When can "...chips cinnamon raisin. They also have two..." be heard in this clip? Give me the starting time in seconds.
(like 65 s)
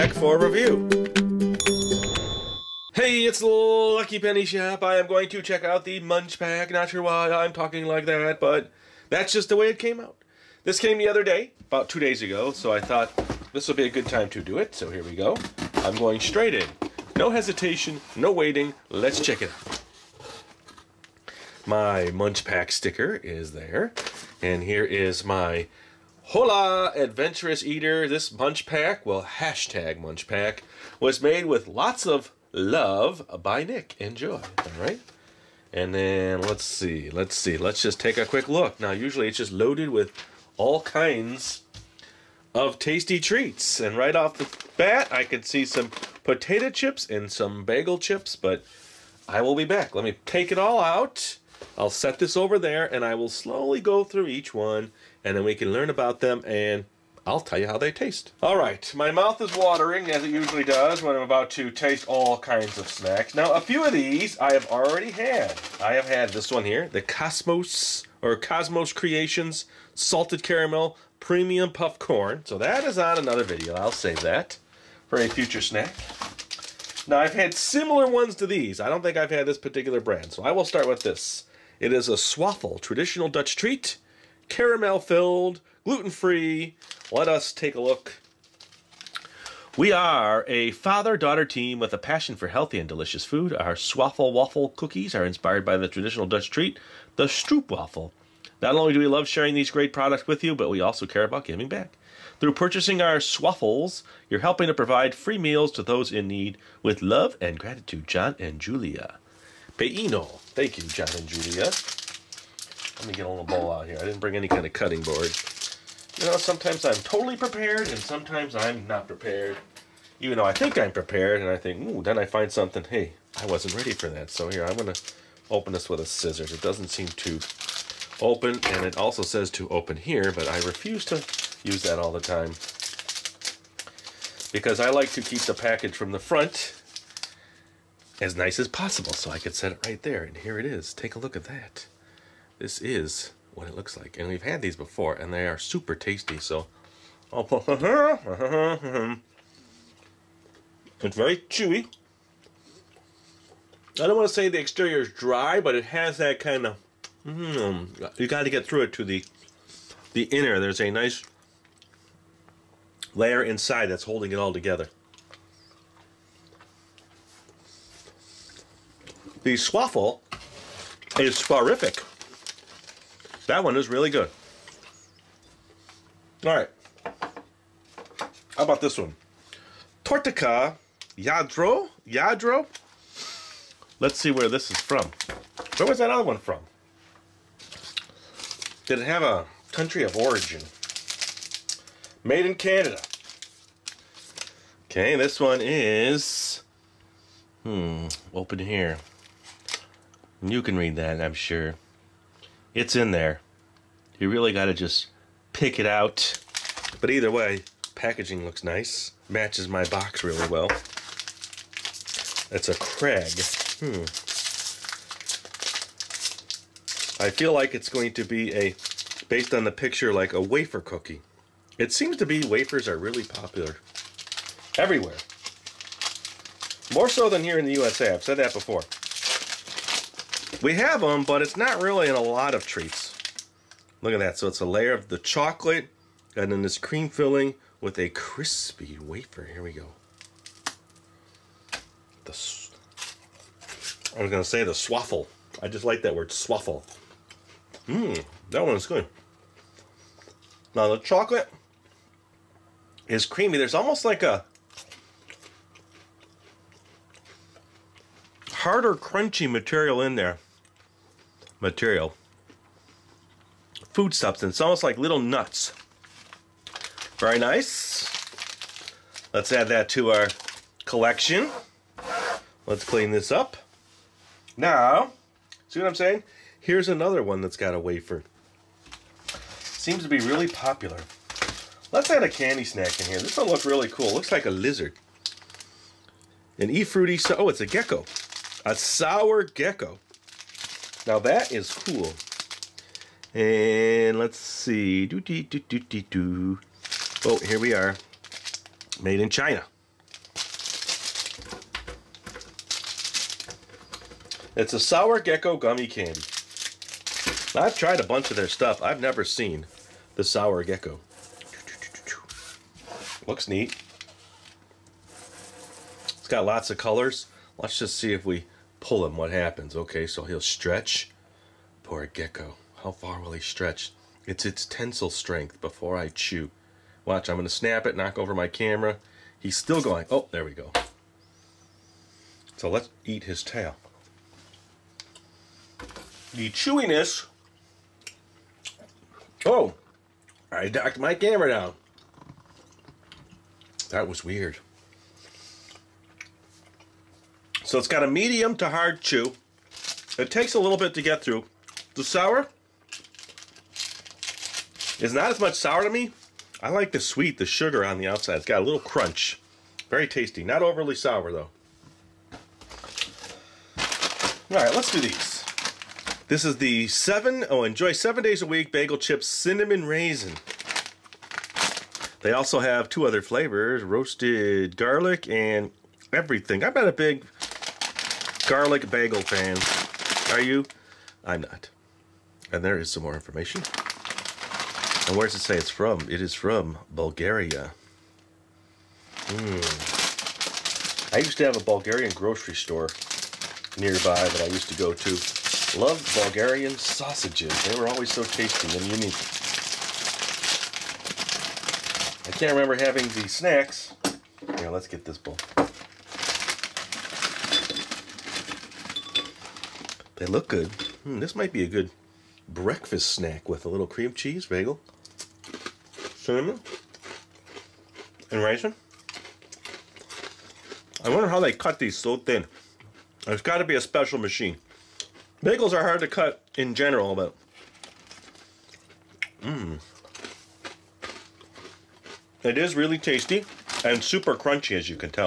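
368 s.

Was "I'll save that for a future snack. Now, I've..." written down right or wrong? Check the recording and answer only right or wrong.
right.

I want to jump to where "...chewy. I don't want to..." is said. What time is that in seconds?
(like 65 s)
151 s.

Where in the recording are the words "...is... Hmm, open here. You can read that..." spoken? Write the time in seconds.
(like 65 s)
195 s.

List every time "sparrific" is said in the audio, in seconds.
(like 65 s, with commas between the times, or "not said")
171 s.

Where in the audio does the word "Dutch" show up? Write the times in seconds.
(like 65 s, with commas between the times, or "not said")
83 s, 96 s.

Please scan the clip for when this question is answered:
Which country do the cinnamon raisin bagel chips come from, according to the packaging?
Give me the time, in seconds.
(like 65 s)
386 s.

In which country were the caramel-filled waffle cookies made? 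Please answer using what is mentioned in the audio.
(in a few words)
Canada.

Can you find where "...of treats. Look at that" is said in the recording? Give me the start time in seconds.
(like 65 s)
232 s.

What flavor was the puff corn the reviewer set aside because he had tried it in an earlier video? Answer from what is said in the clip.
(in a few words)
Salted Caramel.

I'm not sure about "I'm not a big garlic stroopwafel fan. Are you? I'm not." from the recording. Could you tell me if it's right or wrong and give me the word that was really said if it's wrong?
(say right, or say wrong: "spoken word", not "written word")
wrong: "bagel", not "stroopwafel".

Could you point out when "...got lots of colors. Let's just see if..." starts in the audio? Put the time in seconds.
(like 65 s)
316 s.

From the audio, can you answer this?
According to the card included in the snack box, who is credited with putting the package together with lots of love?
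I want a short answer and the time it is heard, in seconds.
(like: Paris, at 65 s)
Nick, at 33 s.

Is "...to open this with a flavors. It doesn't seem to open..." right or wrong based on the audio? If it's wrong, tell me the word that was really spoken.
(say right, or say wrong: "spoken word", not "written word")
wrong: "scissors", not "flavors".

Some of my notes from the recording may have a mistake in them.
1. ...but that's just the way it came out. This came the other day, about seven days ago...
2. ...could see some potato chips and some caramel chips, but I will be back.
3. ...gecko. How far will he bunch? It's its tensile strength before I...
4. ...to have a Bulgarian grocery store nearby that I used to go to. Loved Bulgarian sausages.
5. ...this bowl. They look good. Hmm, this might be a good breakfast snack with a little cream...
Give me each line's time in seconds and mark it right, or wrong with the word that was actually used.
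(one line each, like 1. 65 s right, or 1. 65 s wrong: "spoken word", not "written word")
1. 8 s wrong: "two", not "seven"
2. 45 s wrong: "bagel", not "caramel"
3. 322 s wrong: "stretch", not "bunch"
4. 391 s right
5. 405 s right.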